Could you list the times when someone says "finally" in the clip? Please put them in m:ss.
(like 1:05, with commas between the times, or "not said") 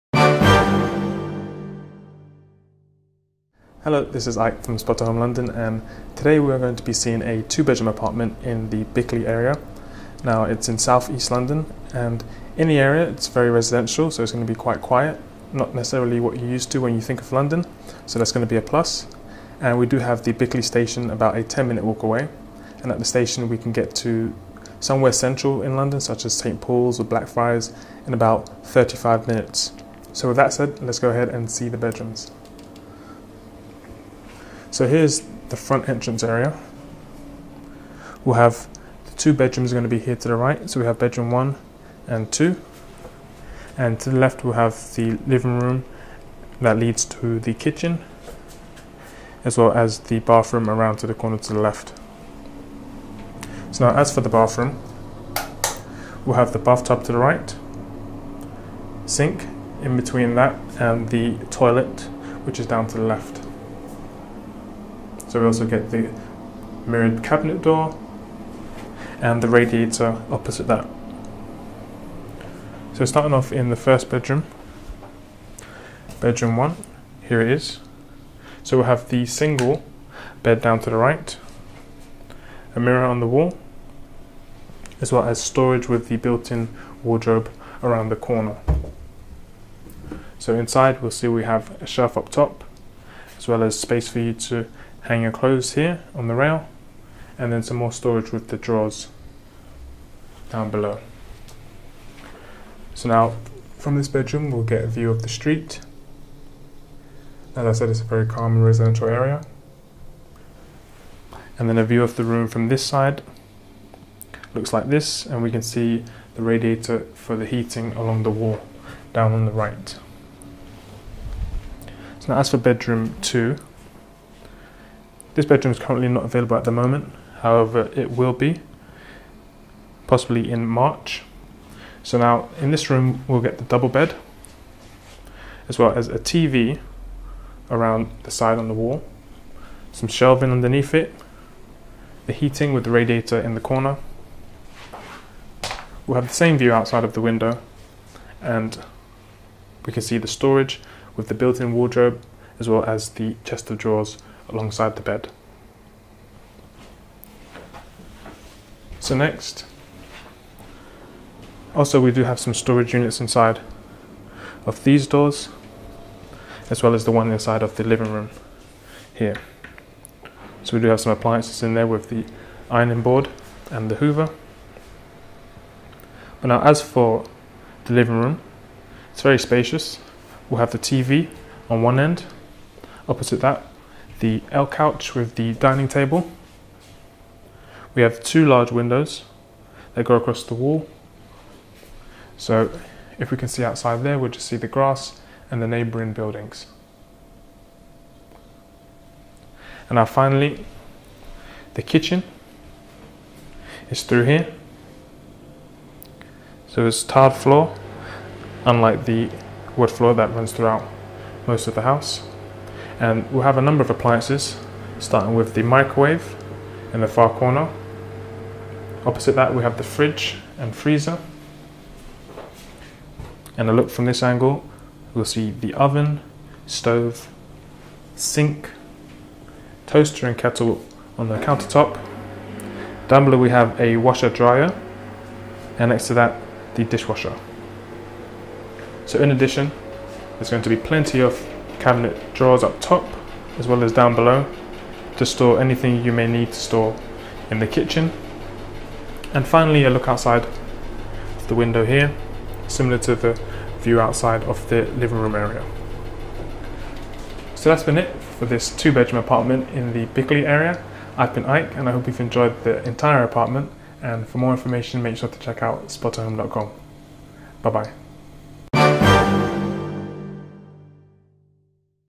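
3:20, 4:09.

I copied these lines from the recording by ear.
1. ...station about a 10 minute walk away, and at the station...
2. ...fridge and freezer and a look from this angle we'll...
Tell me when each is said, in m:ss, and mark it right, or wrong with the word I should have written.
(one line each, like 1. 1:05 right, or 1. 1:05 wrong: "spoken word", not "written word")
1. 0:20 right
2. 3:39 right.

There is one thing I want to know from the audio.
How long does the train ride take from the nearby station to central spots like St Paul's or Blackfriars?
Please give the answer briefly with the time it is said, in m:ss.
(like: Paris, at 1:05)
35 minutes, at 0:28.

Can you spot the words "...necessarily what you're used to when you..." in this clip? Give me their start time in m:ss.
0:15.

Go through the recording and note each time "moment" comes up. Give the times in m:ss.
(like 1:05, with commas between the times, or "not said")
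2:06.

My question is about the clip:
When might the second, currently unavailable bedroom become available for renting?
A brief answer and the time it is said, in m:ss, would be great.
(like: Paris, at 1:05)
March, at 2:10.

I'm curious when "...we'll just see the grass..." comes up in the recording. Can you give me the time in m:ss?
3:14.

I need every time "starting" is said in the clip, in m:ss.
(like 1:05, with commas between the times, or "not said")
1:13, 3:34.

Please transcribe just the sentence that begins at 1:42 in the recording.
So now from this bedroom we'll get a view of the street.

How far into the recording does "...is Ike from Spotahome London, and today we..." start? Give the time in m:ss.
0:04.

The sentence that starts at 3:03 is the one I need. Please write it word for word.
Opposite that, the L couch with the dining table.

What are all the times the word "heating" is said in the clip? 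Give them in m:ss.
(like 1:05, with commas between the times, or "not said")
1:57, 2:22.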